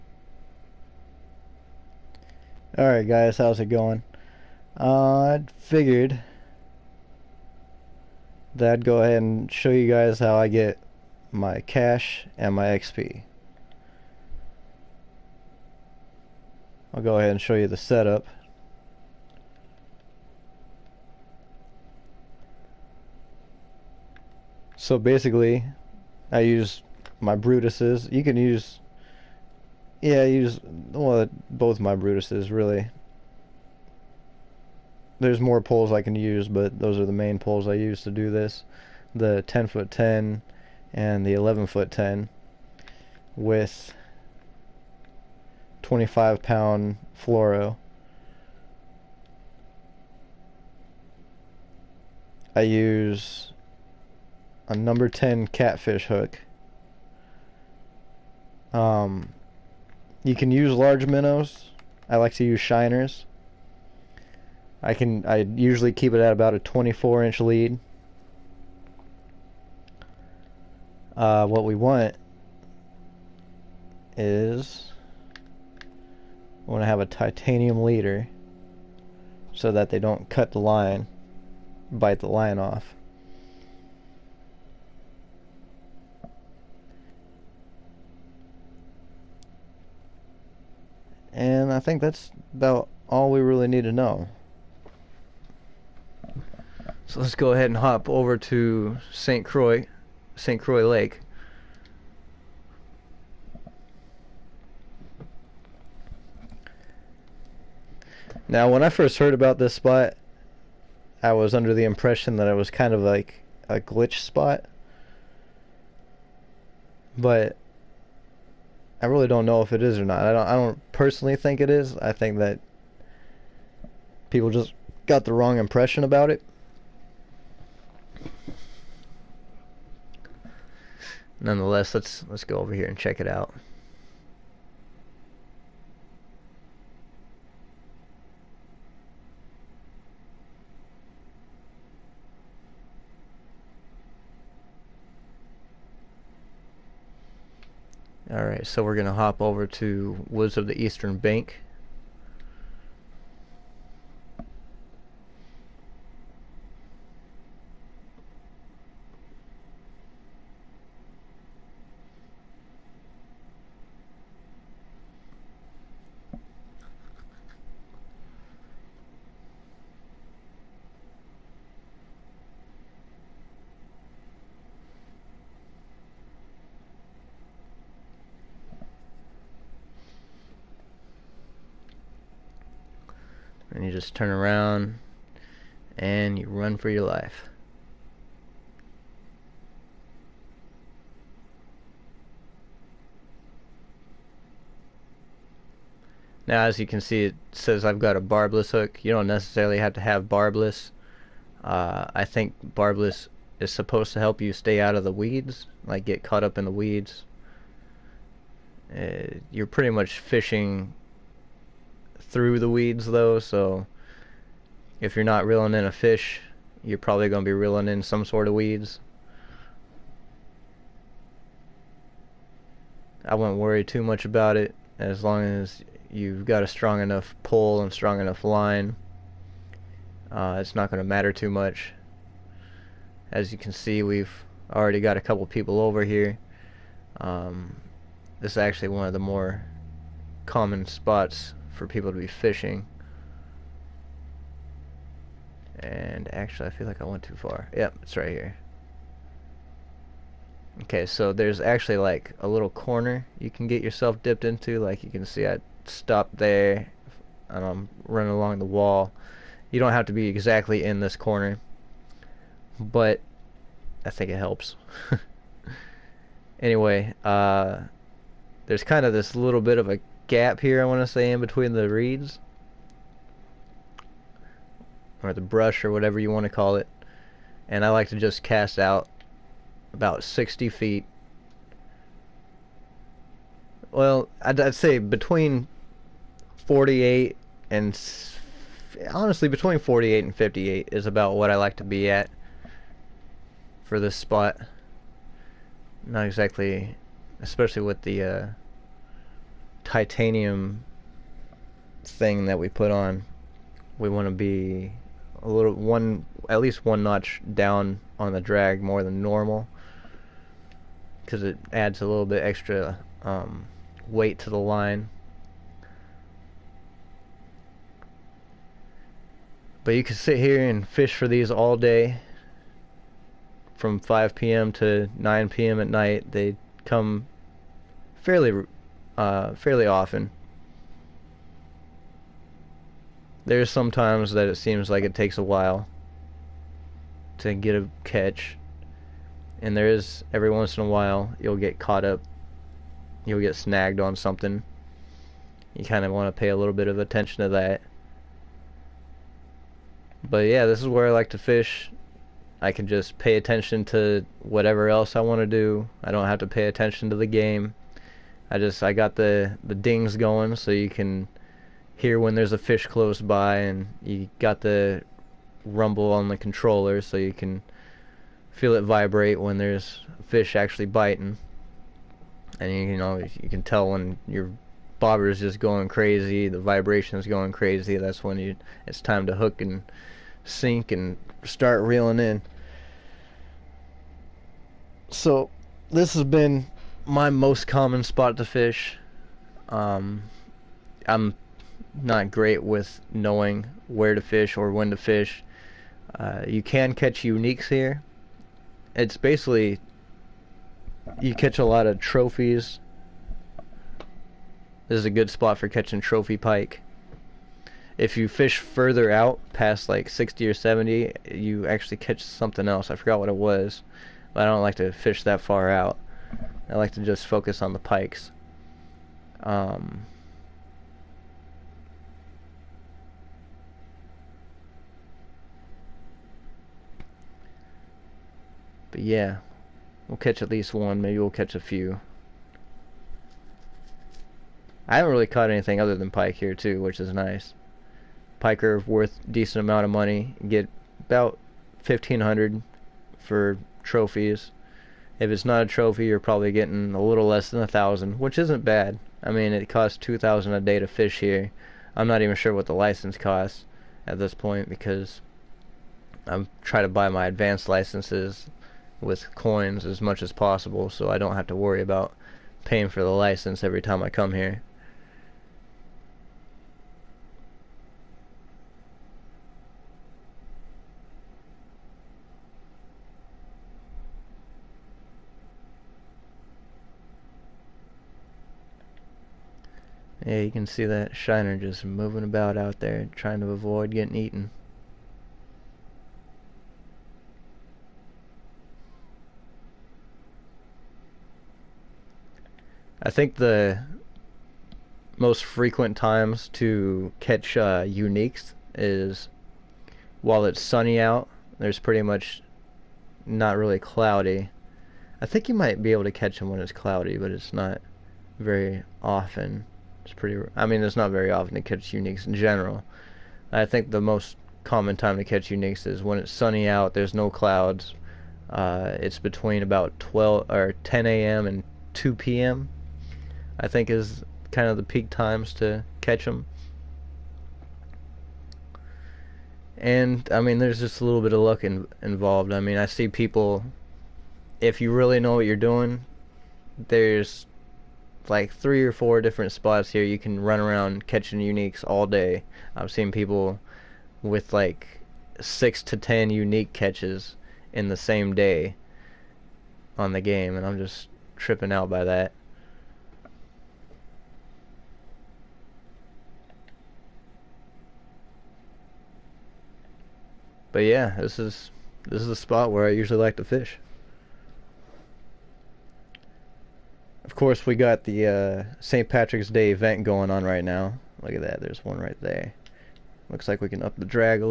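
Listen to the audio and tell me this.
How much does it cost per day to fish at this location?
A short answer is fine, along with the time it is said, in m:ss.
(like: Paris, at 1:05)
2000, at 7:29.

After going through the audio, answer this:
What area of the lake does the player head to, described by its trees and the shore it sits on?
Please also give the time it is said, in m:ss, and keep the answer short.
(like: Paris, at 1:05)
Woods of the Eastern Bank, at 2:30.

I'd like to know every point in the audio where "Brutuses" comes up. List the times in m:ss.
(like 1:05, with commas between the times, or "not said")
0:27, 0:31.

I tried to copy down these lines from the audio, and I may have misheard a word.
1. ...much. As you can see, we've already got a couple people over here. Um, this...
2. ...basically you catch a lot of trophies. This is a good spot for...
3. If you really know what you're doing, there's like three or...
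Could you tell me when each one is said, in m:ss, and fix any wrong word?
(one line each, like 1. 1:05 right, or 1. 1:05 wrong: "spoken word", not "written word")
1. 3:51 right
2. 6:39 right
3. 8:54 right.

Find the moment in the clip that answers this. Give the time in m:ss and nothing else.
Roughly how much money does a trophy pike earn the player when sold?
7:21.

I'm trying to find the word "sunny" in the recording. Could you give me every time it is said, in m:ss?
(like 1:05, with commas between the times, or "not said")
8:20, 8:36.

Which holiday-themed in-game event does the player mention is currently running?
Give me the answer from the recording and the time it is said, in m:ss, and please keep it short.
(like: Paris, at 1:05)
St. Patrick's Day, at 9:28.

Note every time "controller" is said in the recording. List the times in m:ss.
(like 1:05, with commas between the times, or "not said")
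6:06.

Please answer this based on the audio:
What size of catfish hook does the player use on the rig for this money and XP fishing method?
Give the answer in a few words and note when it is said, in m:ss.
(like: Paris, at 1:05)
Number 10, at 0:54.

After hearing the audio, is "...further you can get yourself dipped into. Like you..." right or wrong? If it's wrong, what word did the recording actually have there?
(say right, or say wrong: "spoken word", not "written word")
wrong: "corner", not "further".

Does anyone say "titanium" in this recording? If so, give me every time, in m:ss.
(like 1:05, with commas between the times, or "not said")
1:17, 4:59.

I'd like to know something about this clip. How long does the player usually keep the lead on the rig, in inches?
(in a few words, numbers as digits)
24 inches.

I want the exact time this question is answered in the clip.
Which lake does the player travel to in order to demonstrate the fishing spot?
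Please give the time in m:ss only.
1:40.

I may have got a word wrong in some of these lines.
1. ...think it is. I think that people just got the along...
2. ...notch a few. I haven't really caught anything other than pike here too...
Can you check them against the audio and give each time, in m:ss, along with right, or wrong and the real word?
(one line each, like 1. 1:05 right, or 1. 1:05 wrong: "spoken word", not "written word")
1. 2:01 wrong: "wrong", not "along"
2. 7:11 wrong: "catch", not "notch".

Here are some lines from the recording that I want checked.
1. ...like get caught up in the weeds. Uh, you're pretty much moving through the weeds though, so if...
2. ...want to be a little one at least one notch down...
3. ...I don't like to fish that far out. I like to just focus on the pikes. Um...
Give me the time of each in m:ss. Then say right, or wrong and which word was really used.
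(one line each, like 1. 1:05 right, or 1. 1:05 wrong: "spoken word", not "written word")
1. 3:25 wrong: "fishing", not "moving"
2. 5:04 right
3. 6:54 right.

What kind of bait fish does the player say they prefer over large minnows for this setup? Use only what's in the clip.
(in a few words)
Shiners.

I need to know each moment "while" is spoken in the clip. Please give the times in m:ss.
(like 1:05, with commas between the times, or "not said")
5:35, 5:40, 8:20.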